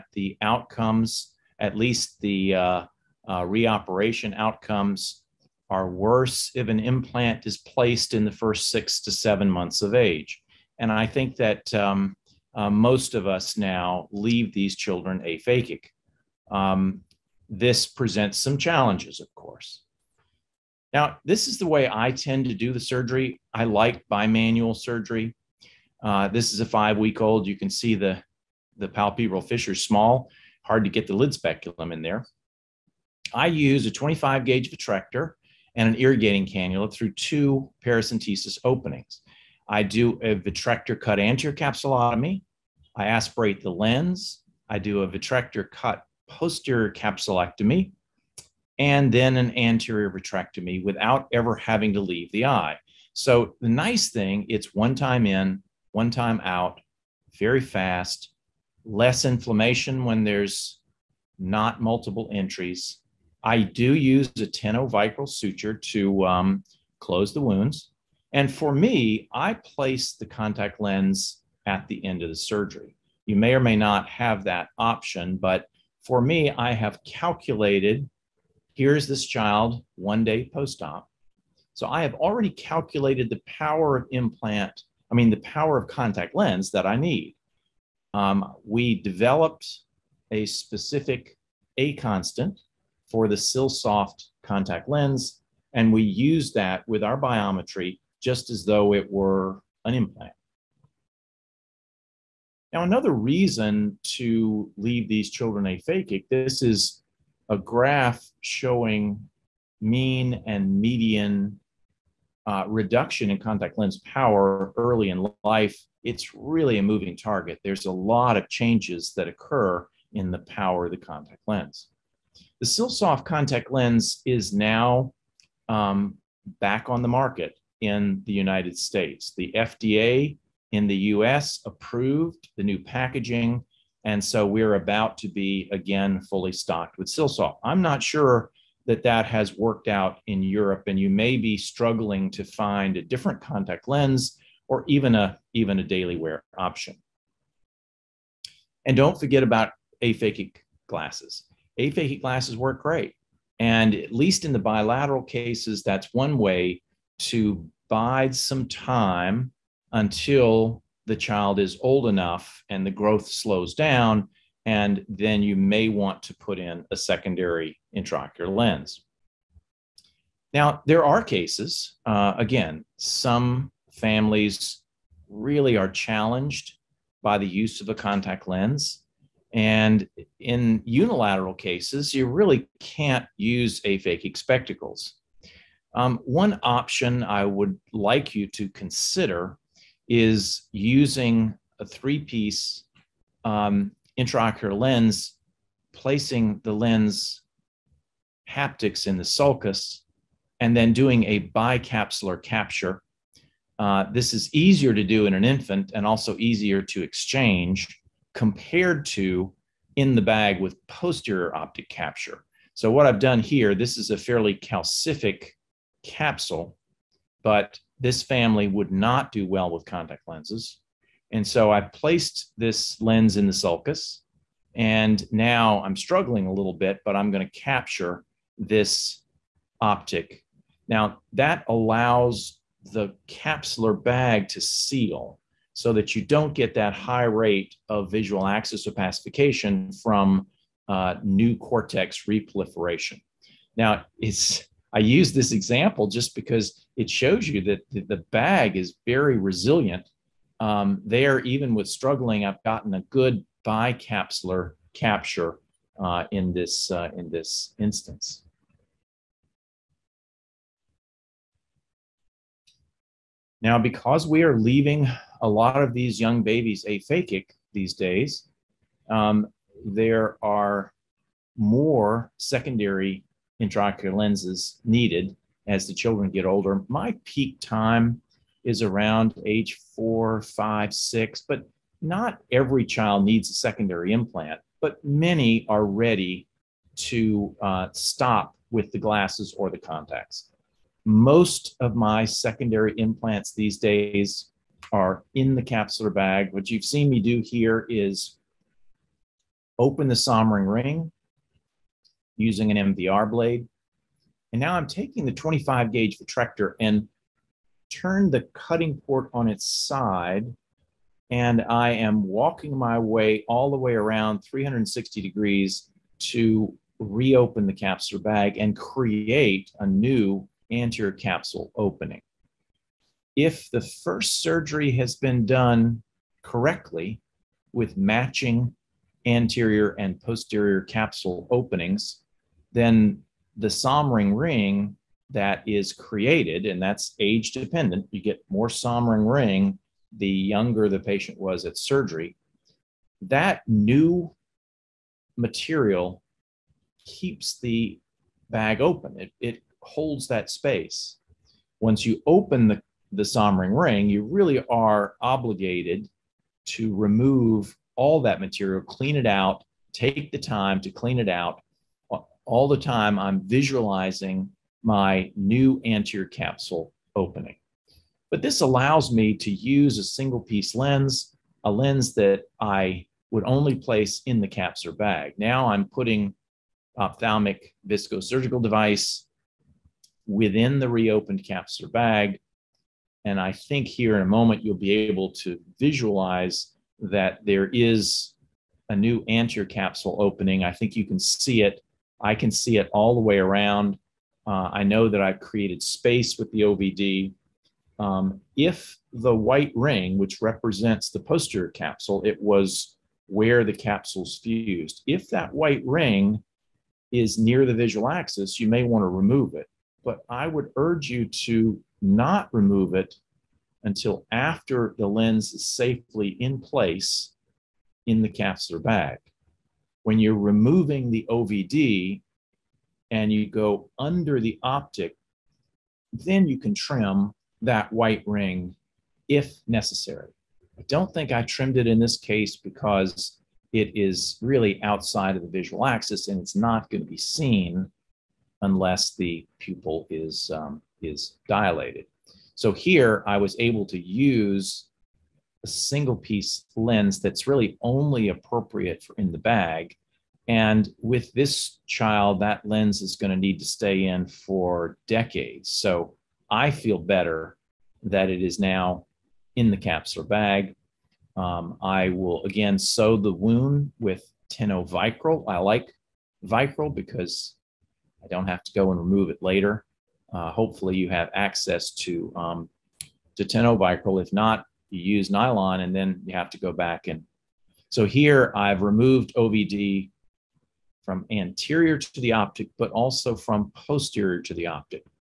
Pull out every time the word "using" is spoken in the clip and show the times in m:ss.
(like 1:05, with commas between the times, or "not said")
3:10, 5:02.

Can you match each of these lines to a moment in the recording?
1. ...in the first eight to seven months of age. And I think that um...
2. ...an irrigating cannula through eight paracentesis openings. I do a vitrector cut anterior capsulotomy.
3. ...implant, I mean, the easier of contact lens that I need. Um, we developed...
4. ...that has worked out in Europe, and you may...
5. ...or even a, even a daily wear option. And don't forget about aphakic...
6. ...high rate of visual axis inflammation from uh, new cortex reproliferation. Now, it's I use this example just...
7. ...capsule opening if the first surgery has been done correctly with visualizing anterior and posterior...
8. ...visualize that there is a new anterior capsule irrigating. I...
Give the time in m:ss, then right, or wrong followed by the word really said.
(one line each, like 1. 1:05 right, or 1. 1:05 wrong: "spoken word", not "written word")
1. 0:08 wrong: "six", not "eight"
2. 0:35 wrong: "two", not "eight"
3. 1:24 wrong: "power", not "easier"
4. 2:19 right
5. 2:24 right
6. 3:56 wrong: "opacification", not "inflammation"
7. 5:21 wrong: "matching", not "visualizing"
8. 6:25 wrong: "opening", not "irrigating".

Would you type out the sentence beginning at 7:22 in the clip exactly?
So here I was able to use a single piece lens that's really only appropriate for in the bag.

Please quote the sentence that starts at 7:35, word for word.
So I feel better that it is now in the capsular bag.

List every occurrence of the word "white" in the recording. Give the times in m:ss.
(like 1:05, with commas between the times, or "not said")
6:39, 6:45, 7:07.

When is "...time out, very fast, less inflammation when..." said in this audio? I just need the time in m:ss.
0:56.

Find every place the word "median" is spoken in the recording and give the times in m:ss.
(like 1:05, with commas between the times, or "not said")
1:50.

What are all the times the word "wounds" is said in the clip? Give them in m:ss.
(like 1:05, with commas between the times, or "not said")
1:07, 7:43.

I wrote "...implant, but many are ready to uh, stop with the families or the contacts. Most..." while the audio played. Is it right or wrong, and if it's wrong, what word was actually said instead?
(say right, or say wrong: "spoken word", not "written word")
wrong: "glasses", not "families".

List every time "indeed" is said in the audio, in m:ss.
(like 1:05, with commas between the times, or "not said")
not said.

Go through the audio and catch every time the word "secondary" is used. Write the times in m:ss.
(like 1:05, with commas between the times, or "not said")
2:46, 4:32, 4:43, 4:52.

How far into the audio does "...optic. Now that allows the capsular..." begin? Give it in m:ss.
3:49.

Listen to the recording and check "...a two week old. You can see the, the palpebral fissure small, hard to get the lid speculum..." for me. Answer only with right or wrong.
wrong.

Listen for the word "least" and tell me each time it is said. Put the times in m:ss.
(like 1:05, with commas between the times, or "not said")
0:01, 2:34.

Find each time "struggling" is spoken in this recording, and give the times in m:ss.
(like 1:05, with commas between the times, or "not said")
2:21, 3:45, 4:11.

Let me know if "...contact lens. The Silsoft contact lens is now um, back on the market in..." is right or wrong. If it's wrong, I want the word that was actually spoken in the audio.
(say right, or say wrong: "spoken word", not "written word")
right.